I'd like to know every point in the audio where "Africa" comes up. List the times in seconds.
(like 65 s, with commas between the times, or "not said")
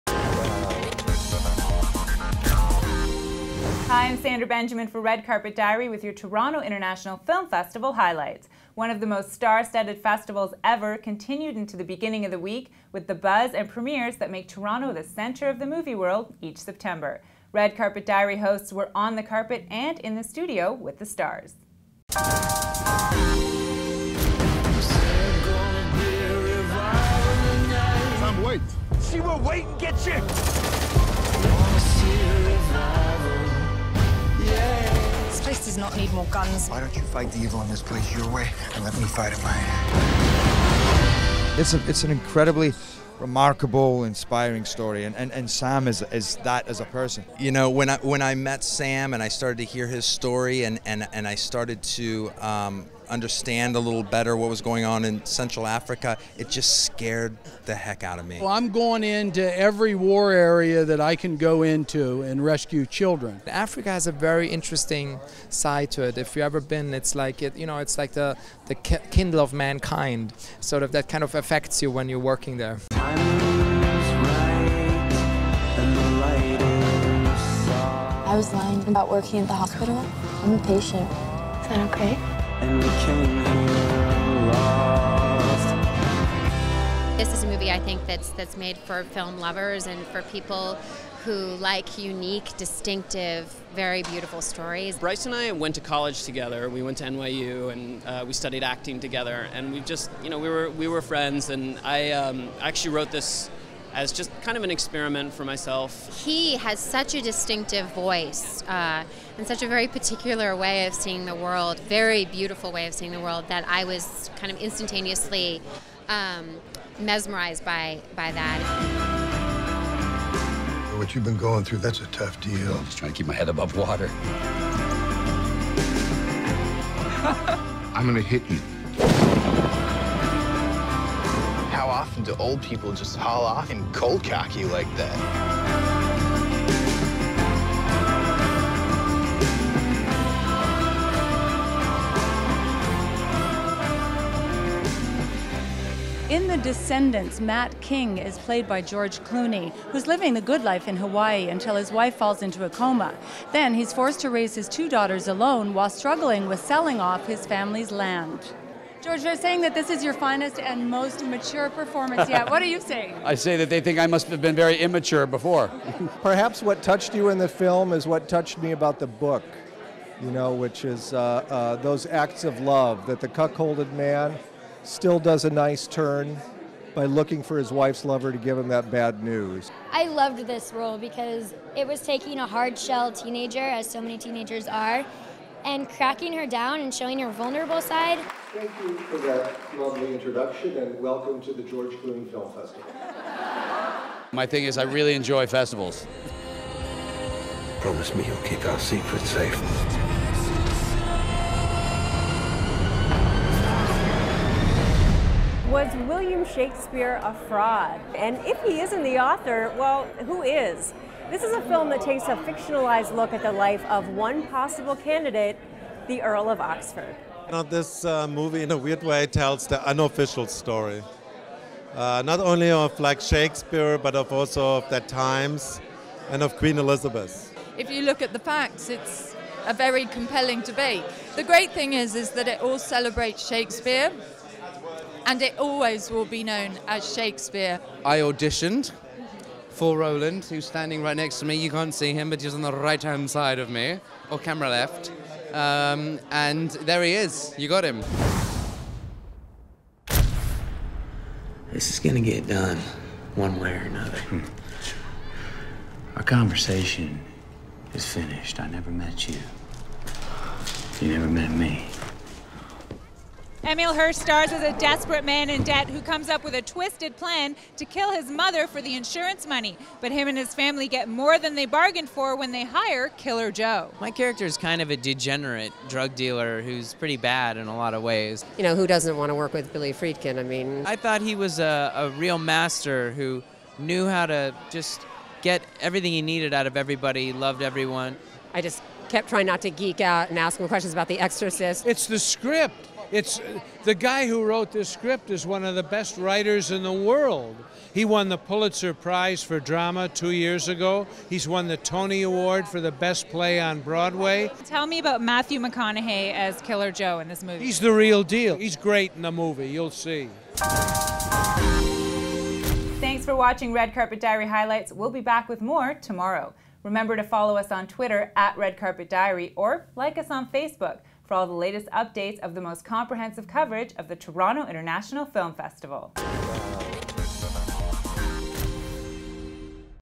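55 s, 63 s.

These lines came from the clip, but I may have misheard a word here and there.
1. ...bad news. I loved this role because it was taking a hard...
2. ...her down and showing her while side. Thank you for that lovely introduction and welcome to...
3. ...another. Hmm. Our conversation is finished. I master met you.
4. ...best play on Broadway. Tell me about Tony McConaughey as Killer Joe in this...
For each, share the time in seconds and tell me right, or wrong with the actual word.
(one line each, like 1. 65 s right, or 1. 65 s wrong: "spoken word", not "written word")
1. 178 s right
2. 186 s wrong: "vulnerable", not "while"
3. 253 s wrong: "never", not "master"
4. 302 s wrong: "Matthew", not "Tony".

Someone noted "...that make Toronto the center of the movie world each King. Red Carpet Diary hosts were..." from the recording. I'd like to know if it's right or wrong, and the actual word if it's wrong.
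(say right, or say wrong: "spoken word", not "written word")
wrong: "September", not "King".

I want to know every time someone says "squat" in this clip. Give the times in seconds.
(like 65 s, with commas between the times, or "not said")
not said.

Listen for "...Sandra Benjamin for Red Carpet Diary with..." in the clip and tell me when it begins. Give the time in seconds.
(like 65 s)
4 s.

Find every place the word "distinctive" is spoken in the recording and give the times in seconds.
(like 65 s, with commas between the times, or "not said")
92 s, 107 s.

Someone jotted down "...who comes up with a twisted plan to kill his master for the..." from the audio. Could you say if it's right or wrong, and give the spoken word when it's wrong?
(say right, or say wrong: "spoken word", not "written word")
wrong: "mother", not "master".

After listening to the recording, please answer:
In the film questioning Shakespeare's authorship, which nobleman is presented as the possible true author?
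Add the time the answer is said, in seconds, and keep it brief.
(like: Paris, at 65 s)
the Earl of Oxford, at 216 s.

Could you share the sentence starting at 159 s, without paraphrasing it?
George, they're saying that this is your finest and most mature performance yet.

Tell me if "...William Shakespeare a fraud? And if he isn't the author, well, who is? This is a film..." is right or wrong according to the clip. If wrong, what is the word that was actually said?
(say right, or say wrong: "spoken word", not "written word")
right.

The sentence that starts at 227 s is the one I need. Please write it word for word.
If you look at the facts, it's a very compelling debate.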